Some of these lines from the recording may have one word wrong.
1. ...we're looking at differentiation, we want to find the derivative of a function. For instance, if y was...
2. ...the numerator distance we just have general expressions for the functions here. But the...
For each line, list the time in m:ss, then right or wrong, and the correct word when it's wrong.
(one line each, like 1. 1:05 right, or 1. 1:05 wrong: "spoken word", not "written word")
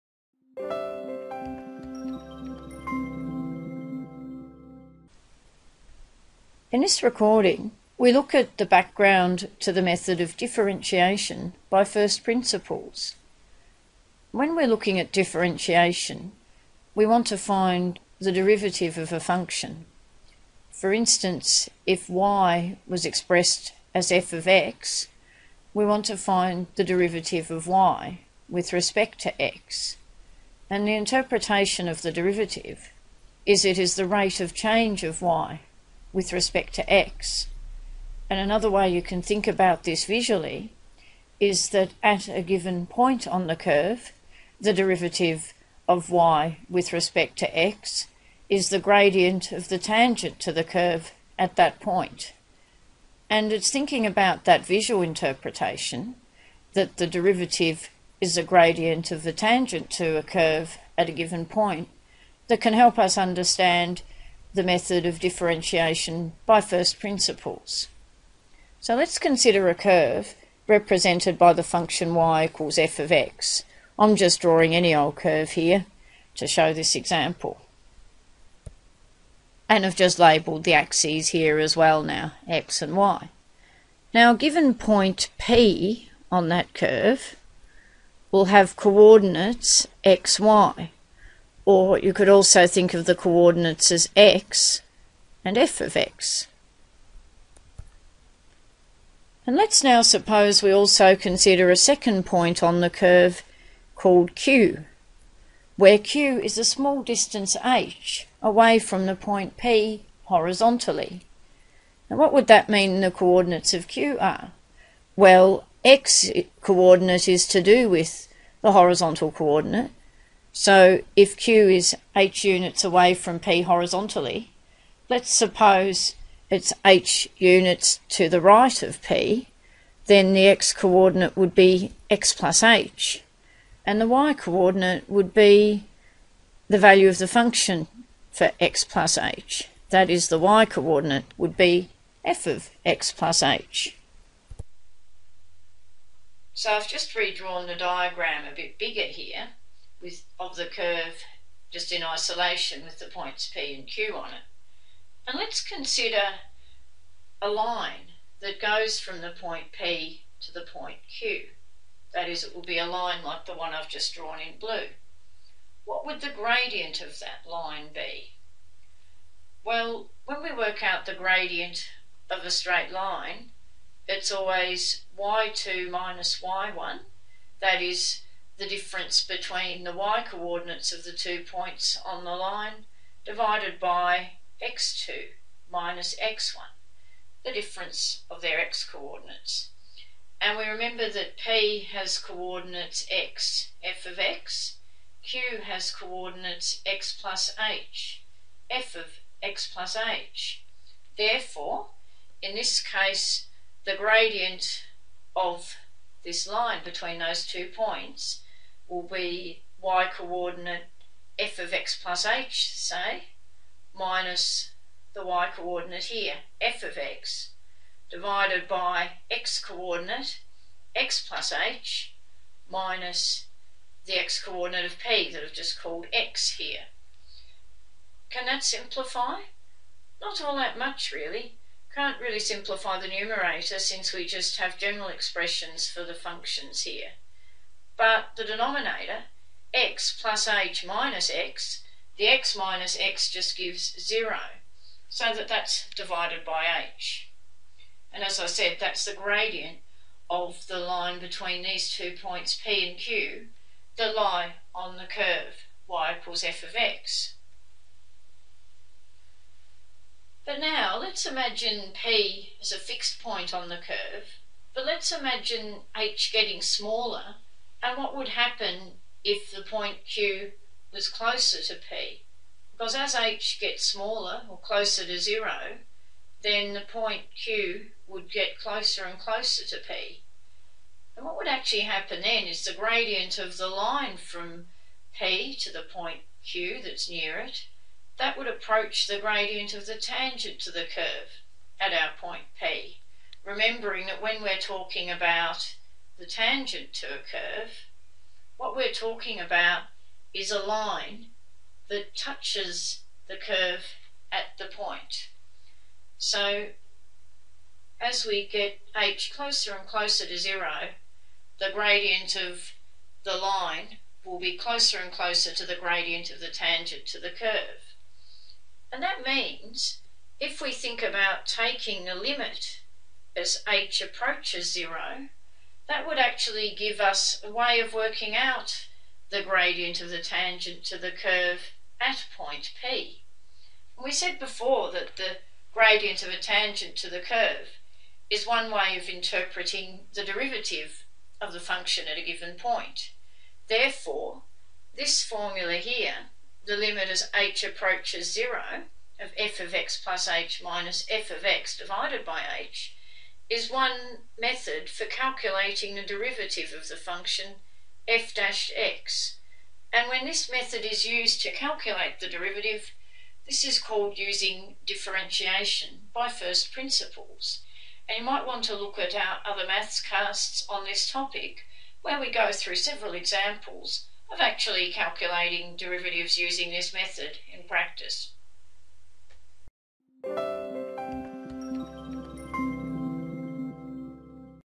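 1. 0:14 right
2. 3:52 wrong: "since", not "distance".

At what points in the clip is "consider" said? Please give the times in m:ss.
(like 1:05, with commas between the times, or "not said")
1:09, 1:41, 2:35.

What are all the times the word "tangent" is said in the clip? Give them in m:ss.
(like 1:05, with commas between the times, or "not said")
0:49, 0:59, 4:49, 4:56, 5:16, 5:30, 5:36.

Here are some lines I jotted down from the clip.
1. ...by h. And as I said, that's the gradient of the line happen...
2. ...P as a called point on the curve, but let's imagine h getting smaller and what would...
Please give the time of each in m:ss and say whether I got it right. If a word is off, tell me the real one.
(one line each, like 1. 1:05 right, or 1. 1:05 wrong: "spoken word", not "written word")
1. 4:06 wrong: "between", not "happen"
2. 4:21 wrong: "fixed", not "called".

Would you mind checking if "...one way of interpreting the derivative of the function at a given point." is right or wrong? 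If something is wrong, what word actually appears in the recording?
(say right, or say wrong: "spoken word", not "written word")
right.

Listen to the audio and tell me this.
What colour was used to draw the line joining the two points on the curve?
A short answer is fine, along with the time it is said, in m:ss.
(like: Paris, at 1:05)
Blue, at 2:44.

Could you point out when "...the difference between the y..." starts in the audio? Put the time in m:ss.
2:58.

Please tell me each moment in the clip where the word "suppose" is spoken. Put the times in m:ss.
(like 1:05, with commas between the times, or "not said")
1:40, 2:05.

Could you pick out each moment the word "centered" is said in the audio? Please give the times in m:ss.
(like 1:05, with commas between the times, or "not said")
not said.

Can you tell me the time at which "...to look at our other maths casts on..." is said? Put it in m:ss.
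6:08.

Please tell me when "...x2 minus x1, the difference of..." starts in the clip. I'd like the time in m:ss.
3:04.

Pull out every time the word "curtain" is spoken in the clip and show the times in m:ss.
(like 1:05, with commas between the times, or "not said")
not said.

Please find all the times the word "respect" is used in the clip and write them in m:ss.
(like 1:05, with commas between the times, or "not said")
0:28, 0:36, 0:46.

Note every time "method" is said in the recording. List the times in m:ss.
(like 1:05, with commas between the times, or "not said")
0:09, 1:04, 5:54, 6:00, 6:16.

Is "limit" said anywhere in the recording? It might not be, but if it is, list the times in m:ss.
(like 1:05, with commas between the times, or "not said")
5:22, 5:46.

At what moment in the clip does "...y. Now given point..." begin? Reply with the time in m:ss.
1:22.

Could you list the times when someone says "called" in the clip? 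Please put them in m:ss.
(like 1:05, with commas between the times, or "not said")
1:43, 3:45, 6:03.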